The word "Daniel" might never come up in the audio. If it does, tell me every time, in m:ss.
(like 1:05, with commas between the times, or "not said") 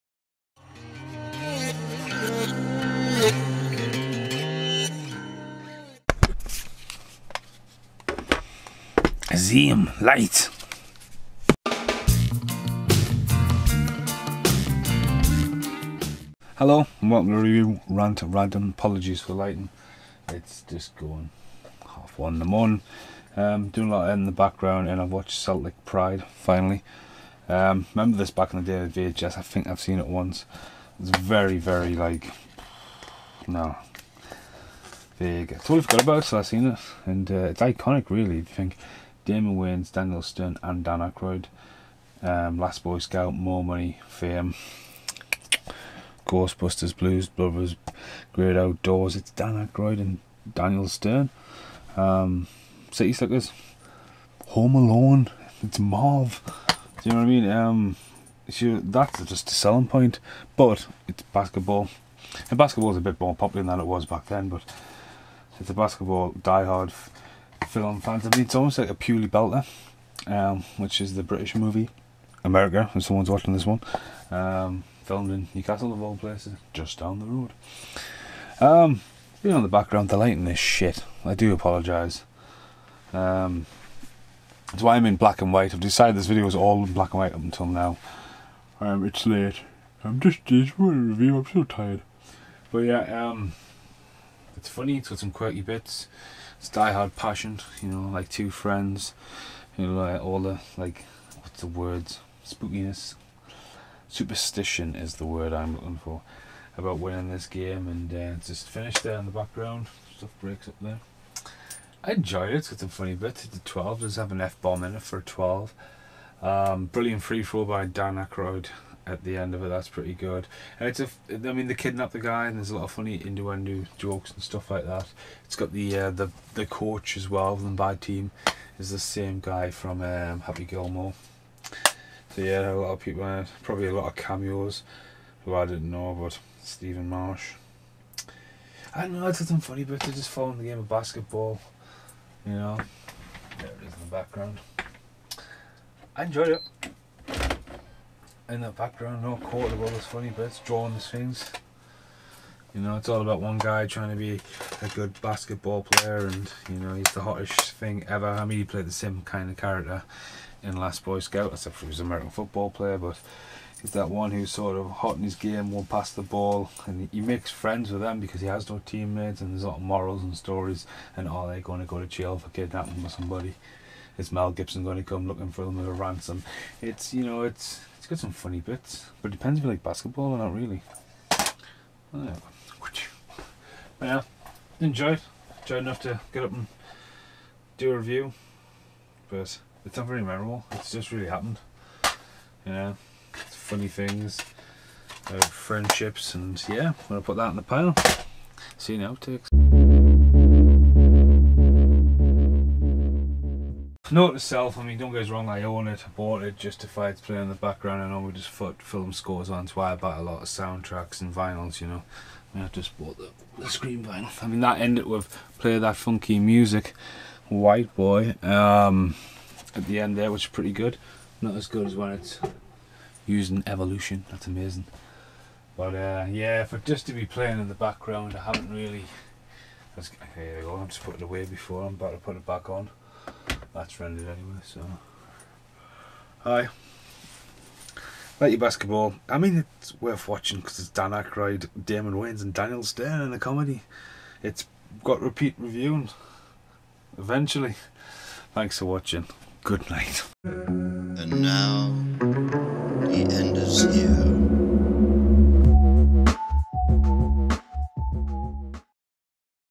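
0:39, 0:50, 4:02.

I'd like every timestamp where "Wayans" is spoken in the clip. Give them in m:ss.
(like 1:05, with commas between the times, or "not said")
0:39, 4:02.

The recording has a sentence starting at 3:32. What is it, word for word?
I, mean, I just bought the, the screen vinyl.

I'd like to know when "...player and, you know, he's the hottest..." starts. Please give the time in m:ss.
2:35.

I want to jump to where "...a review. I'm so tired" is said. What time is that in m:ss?
1:30.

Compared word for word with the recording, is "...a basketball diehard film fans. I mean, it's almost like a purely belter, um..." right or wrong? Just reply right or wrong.
right.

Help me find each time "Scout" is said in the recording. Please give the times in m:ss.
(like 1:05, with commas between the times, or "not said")
0:42, 2:41.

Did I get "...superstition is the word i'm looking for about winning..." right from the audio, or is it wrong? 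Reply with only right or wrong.
right.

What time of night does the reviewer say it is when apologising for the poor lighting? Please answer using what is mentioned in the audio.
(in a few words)
half one in the morning.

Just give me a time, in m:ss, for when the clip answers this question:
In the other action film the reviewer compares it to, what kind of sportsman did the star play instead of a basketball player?
2:42.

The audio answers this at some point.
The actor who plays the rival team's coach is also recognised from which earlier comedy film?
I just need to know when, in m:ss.
2:10.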